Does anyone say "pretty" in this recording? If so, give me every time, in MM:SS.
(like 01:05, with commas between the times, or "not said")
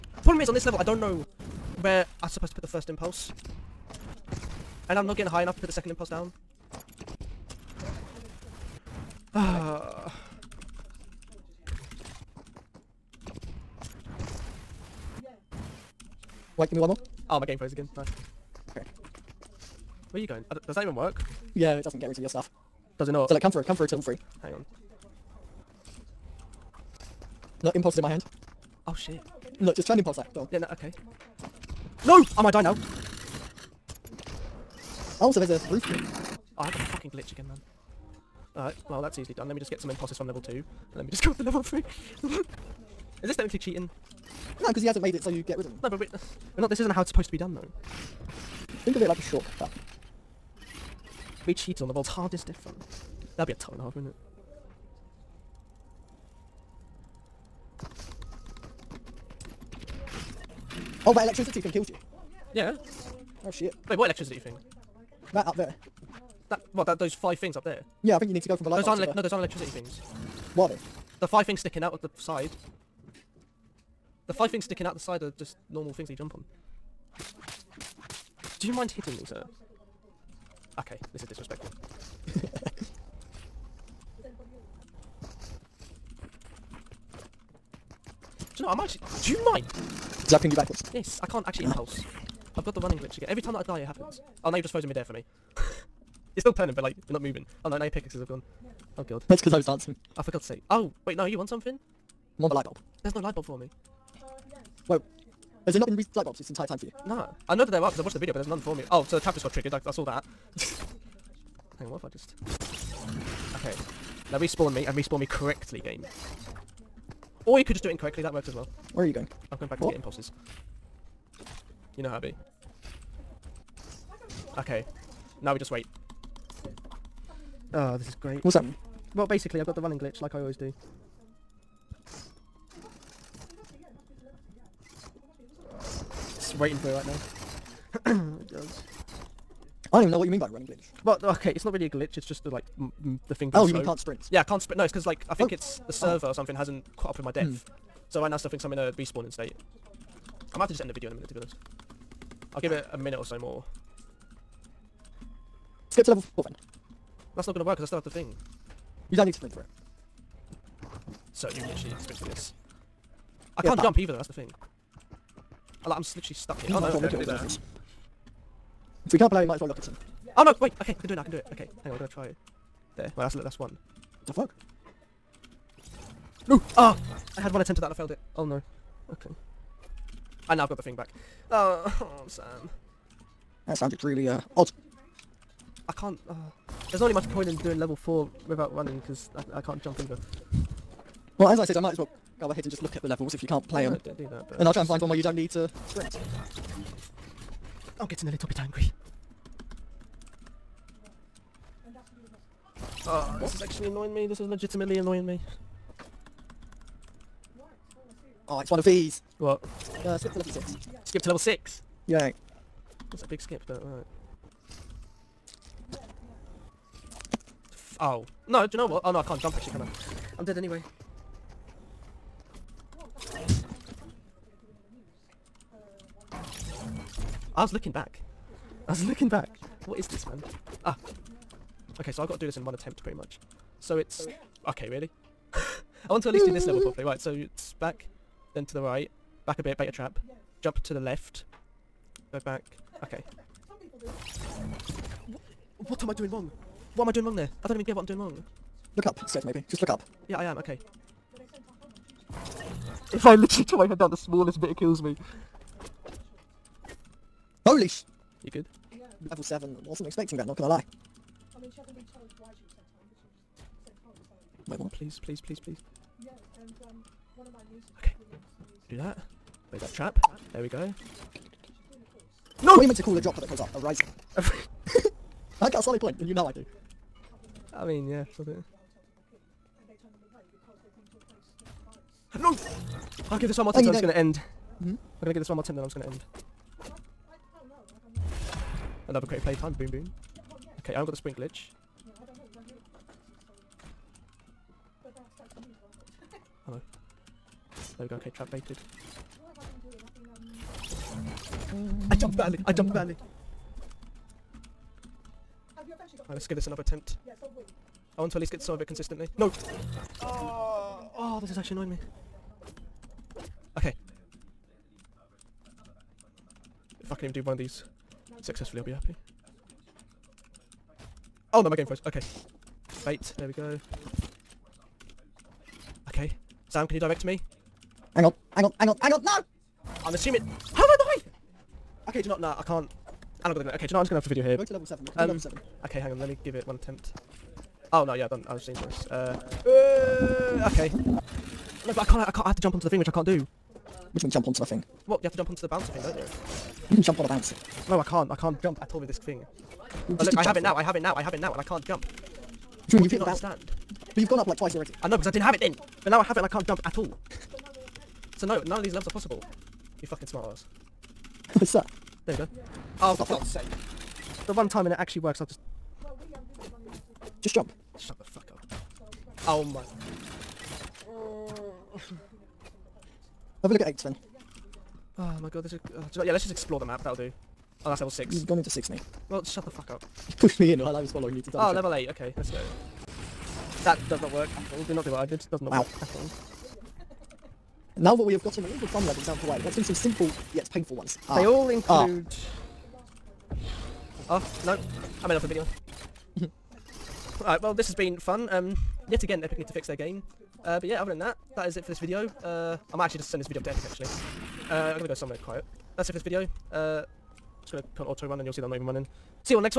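03:53.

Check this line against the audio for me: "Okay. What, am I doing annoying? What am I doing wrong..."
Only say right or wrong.
wrong.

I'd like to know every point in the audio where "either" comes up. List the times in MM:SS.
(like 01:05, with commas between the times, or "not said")
02:43, 03:09.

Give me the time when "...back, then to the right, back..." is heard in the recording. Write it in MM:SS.
03:57.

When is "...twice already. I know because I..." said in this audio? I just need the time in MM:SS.
05:54.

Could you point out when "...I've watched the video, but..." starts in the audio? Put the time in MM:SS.
01:47.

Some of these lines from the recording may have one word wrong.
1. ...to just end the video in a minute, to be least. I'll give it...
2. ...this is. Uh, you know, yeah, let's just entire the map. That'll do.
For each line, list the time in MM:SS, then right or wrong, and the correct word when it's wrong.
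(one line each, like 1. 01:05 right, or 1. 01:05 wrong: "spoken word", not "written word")
1. 02:30 wrong: "honest", not "least"
2. 06:15 wrong: "explore", not "entire".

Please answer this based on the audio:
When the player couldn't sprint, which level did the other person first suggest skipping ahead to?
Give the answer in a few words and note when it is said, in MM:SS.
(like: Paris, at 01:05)
level 4, at 02:35.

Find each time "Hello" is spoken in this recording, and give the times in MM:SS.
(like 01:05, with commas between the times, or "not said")
04:56.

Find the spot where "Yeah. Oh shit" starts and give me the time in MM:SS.
01:02.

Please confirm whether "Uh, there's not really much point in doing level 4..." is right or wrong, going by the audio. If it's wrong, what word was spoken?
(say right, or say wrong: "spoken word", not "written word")
right.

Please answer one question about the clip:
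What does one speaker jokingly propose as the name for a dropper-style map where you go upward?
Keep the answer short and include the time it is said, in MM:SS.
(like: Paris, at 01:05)
A rising, at 04:33.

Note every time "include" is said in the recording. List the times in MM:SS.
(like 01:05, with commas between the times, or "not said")
06:31.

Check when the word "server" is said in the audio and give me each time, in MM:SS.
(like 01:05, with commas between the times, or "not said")
02:25.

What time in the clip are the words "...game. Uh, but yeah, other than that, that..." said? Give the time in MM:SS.
06:39.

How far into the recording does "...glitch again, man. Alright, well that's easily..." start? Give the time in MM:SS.
00:37.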